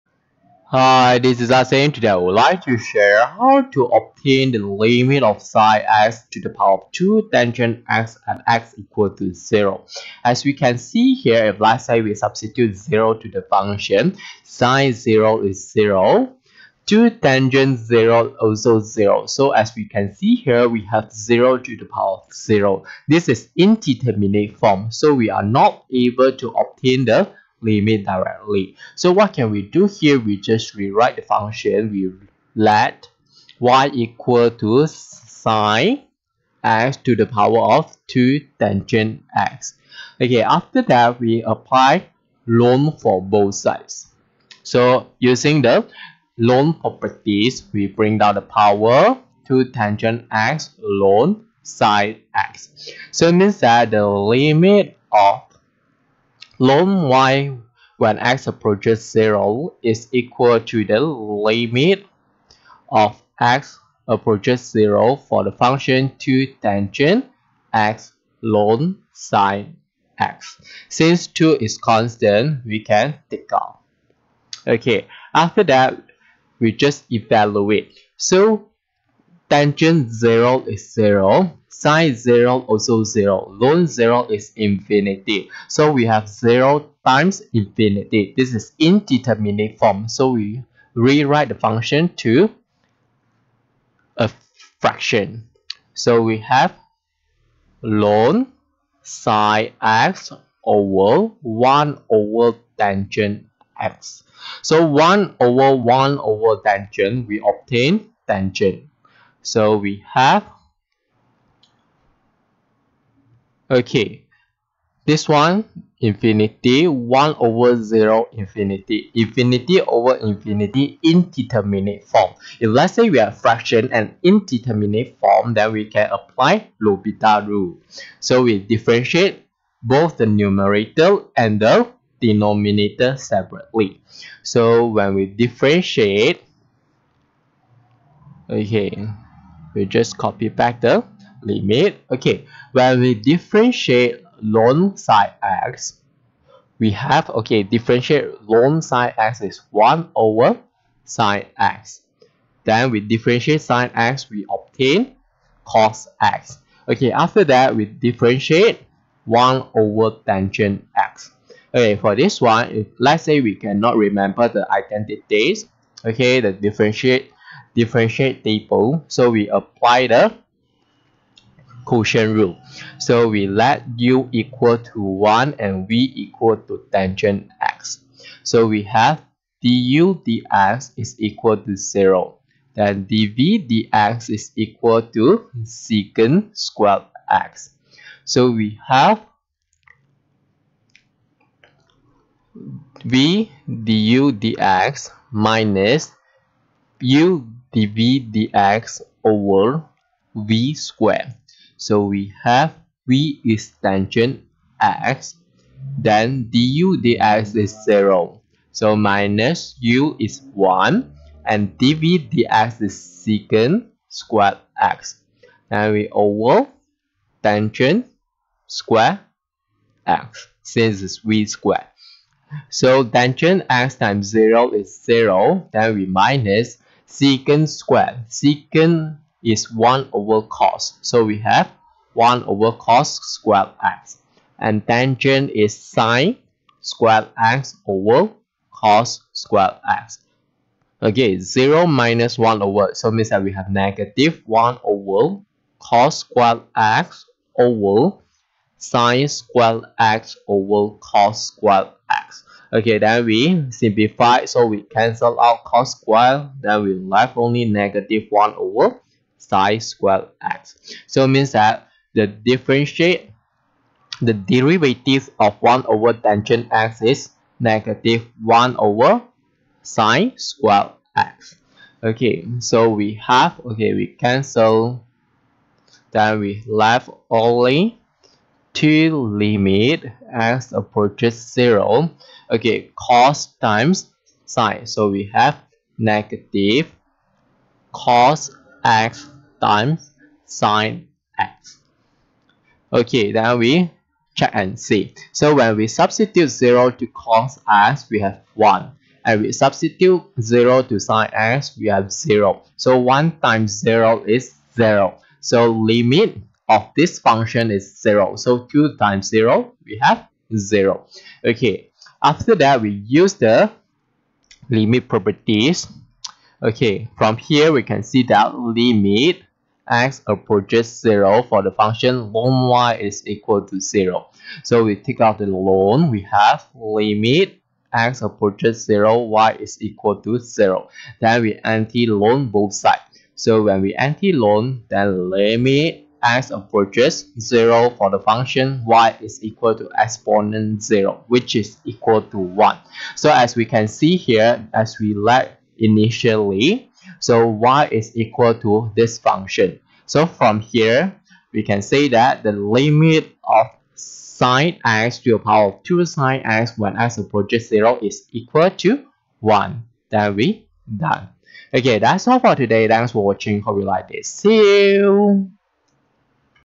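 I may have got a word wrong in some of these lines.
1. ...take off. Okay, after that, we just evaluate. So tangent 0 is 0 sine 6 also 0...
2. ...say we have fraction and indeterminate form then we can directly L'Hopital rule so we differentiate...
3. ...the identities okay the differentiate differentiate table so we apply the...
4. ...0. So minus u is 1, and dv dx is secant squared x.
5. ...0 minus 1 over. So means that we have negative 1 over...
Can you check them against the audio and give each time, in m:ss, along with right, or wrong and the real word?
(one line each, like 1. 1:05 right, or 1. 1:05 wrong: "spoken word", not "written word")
1. 1:13 wrong: "0", not "6"
2. 2:02 wrong: "apply", not "directly"
3. 2:44 right
4. 3:27 right
5. 4:01 right.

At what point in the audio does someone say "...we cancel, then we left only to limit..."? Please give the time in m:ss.
4:33.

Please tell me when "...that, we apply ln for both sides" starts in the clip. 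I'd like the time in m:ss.
0:40.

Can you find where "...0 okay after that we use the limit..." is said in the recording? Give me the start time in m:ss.
5:10.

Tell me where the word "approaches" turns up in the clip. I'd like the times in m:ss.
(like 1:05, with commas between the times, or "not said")
0:58, 1:04, 4:40, 5:20, 5:28, 5:36, 5:57.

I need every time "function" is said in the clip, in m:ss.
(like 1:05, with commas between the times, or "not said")
0:13, 0:31, 1:05, 1:31, 5:07, 5:21, 5:38, 5:49.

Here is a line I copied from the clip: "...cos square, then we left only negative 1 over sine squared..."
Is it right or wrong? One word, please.
right.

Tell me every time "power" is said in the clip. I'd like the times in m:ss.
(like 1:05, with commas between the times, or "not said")
0:06, 0:21, 0:37, 0:48, 5:55.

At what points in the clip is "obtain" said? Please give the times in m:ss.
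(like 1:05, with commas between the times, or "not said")
0:03, 0:26, 1:47, 2:34.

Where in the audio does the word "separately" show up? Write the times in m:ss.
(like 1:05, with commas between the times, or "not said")
2:13.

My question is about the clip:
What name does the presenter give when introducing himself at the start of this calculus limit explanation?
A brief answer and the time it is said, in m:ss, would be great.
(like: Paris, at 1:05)
Asim, at 0:01.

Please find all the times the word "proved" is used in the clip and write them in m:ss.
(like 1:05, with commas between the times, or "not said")
not said.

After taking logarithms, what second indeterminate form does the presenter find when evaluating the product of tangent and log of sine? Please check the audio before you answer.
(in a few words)
0 times infinity.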